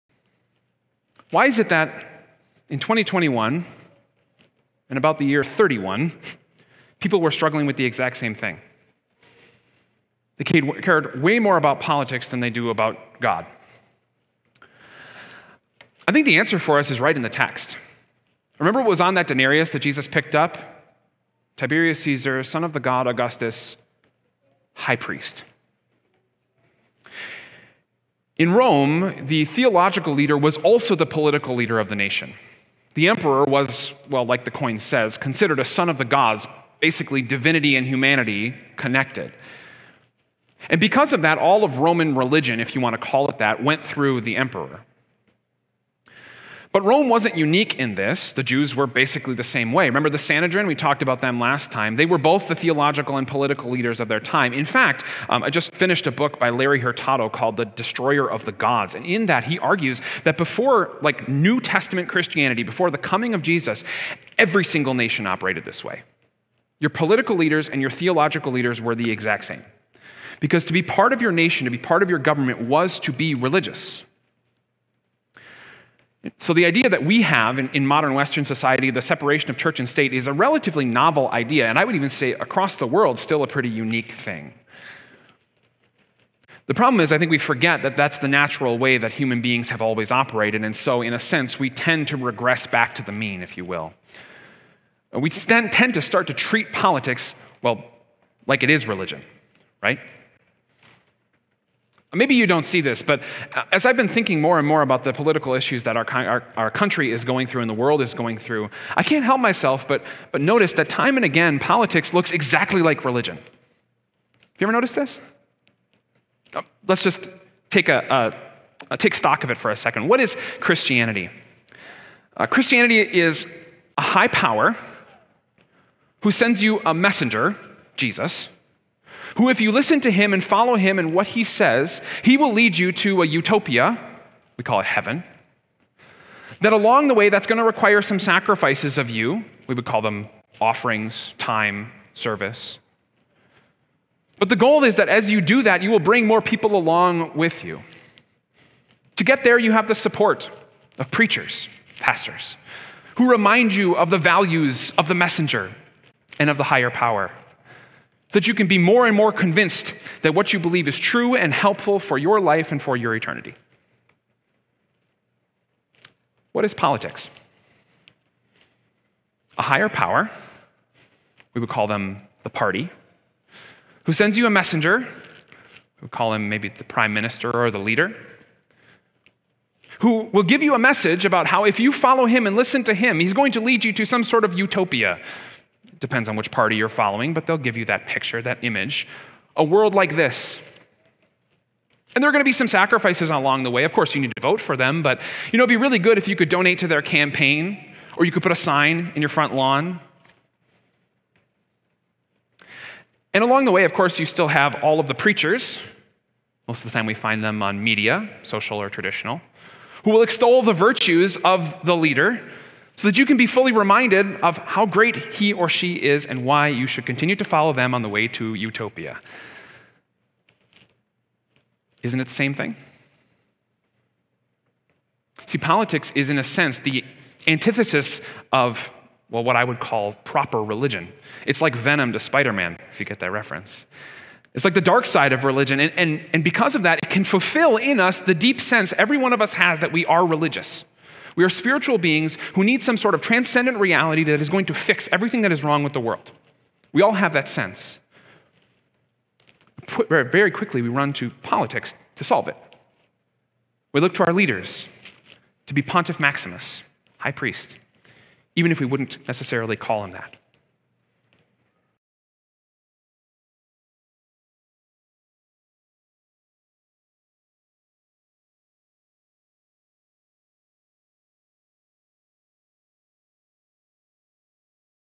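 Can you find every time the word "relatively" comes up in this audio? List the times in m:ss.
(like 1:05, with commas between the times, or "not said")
1:20.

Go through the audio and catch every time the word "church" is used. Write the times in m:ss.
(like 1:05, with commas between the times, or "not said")
1:19.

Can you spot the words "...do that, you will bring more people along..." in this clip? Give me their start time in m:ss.
2:25.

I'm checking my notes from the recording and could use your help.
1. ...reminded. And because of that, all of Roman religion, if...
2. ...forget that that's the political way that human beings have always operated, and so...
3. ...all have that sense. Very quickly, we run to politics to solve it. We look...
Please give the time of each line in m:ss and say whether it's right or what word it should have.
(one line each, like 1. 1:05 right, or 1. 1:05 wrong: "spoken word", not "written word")
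1. 0:38 wrong: "connected", not "reminded"
2. 1:27 wrong: "natural", not "political"
3. 4:07 right.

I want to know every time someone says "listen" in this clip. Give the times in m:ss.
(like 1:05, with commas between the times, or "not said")
2:09, 3:02.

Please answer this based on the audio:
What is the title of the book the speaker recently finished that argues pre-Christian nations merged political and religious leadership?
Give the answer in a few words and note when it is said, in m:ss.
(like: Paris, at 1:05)
The Destroyer of the Gods, at 0:57.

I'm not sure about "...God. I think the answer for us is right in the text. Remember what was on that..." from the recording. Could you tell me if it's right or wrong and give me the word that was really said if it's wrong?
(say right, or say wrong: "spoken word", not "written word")
right.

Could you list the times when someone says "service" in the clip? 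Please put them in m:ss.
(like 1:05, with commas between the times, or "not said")
2:22.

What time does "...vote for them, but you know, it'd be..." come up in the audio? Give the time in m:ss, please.
3:14.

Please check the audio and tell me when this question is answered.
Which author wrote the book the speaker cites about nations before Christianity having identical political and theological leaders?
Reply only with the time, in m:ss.
0:56.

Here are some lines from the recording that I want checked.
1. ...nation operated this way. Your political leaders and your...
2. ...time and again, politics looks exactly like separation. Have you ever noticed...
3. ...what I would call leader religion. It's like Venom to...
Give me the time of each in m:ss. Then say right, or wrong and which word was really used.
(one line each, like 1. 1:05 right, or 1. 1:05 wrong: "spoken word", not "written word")
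1. 1:04 right
2. 1:50 wrong: "religion", not "separation"
3. 3:49 wrong: "proper", not "leader".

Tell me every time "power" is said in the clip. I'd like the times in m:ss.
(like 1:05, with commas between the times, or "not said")
2:04, 2:36, 2:49.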